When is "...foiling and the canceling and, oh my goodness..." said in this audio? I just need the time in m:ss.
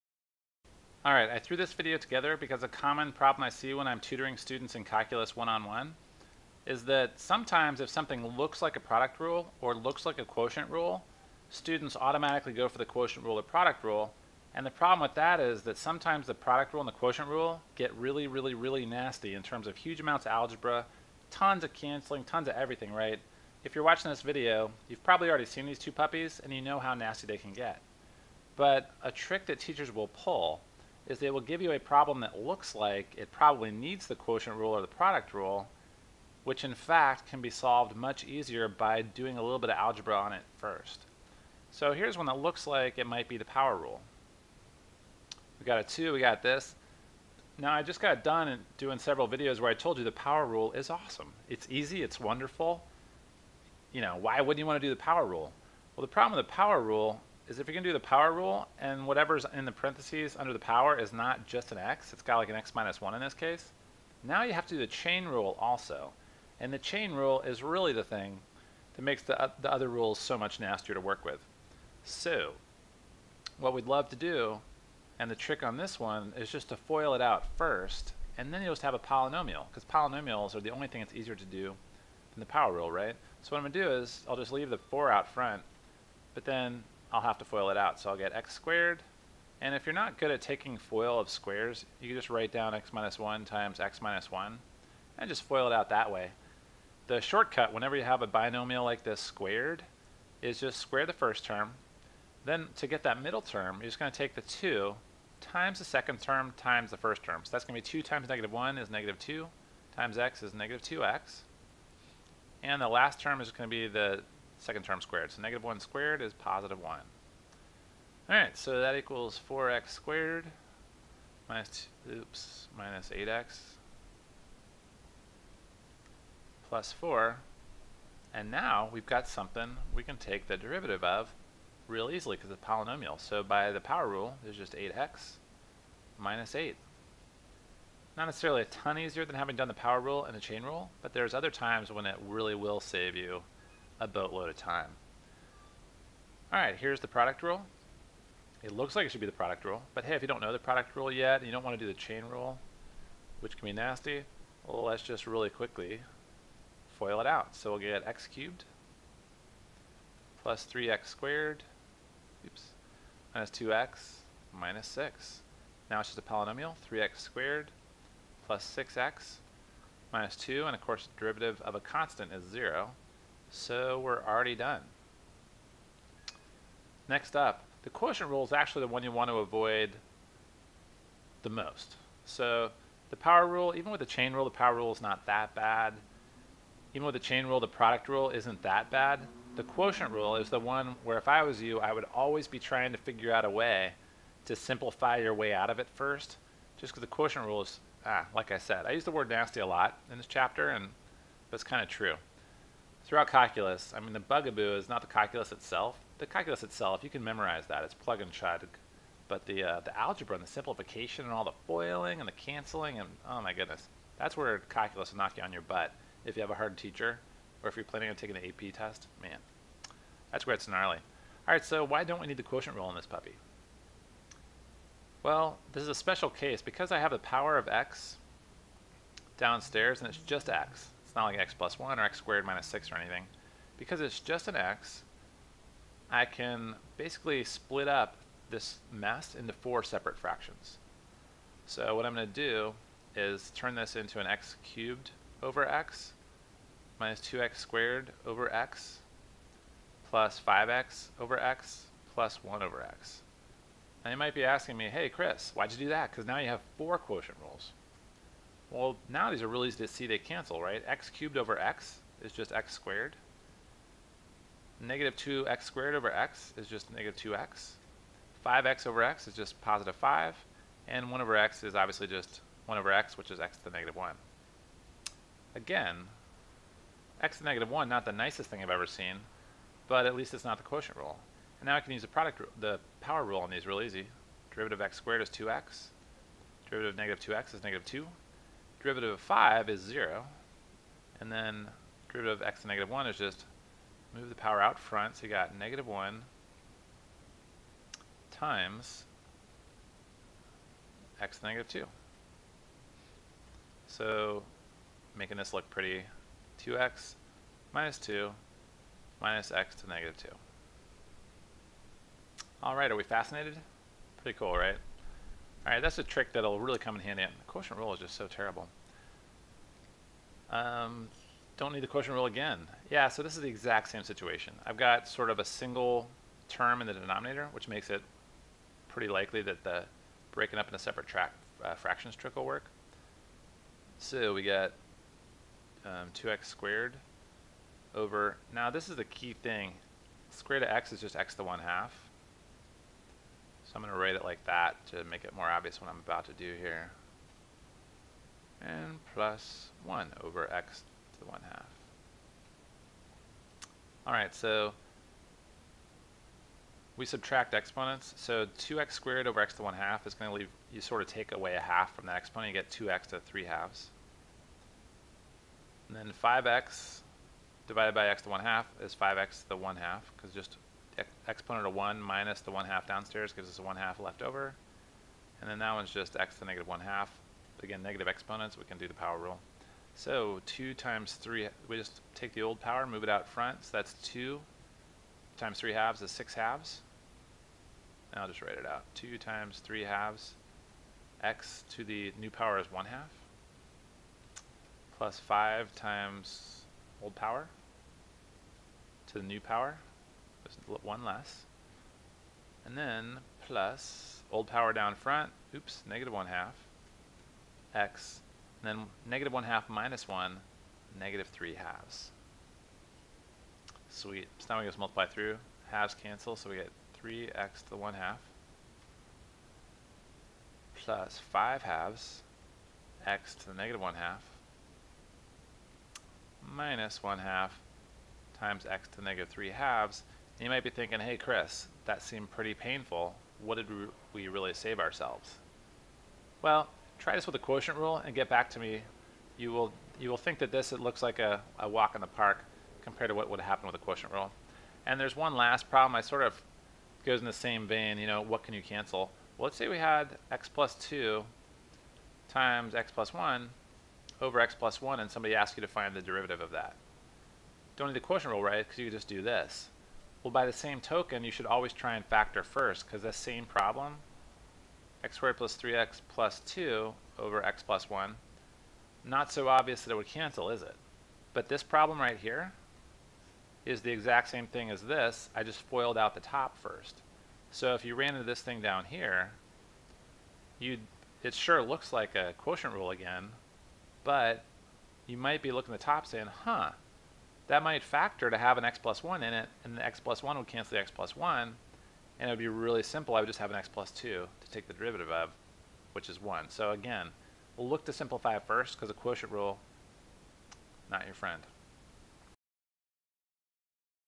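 3:31.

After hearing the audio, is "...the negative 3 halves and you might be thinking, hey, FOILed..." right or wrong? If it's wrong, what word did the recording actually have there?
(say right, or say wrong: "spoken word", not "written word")
wrong: "Chris", not "FOILed".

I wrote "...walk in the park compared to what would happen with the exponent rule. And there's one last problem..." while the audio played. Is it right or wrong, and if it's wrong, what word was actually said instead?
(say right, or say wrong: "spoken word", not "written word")
wrong: "quotient", not "exponent".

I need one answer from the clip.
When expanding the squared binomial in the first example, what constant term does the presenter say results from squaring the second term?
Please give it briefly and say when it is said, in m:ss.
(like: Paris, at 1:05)
positive 1, at 1:56.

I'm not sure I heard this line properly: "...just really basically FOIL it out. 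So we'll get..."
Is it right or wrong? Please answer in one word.
wrong.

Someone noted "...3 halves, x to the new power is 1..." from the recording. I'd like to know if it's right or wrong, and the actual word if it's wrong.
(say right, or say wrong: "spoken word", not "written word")
right.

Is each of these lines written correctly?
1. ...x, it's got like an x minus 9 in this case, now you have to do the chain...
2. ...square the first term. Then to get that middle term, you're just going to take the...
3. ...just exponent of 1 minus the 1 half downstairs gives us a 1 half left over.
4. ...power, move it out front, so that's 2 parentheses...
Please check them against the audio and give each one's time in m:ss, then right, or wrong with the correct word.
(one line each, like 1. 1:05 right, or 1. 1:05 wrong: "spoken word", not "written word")
1. 1:01 wrong: "1", not "9"
2. 1:40 right
3. 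6:10 right
4. 6:22 wrong: "times", not "parentheses".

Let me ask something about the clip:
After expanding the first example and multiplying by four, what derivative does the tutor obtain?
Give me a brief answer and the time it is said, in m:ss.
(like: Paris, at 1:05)
8x minus 8, at 2:14.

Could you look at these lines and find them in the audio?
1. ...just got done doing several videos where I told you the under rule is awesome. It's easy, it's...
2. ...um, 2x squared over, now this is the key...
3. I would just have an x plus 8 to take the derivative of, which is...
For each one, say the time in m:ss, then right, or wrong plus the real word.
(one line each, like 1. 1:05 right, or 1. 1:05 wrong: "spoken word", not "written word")
1. 0:47 wrong: "power", not "under"
2. 5:35 right
3. 8:13 wrong: "2", not "8".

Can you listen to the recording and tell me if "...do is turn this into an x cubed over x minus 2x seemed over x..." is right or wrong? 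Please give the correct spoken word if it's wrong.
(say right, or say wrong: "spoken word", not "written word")
wrong: "squared", not "seemed".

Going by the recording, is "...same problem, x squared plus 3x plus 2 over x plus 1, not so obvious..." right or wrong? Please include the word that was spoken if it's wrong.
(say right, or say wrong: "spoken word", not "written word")
right.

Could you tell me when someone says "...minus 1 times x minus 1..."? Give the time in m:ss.
1:32.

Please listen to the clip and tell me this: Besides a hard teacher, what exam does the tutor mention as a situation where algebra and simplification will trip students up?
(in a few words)
AP test.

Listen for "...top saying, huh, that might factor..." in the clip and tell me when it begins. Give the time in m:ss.
8:05.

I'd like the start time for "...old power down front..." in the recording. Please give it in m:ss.
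6:44.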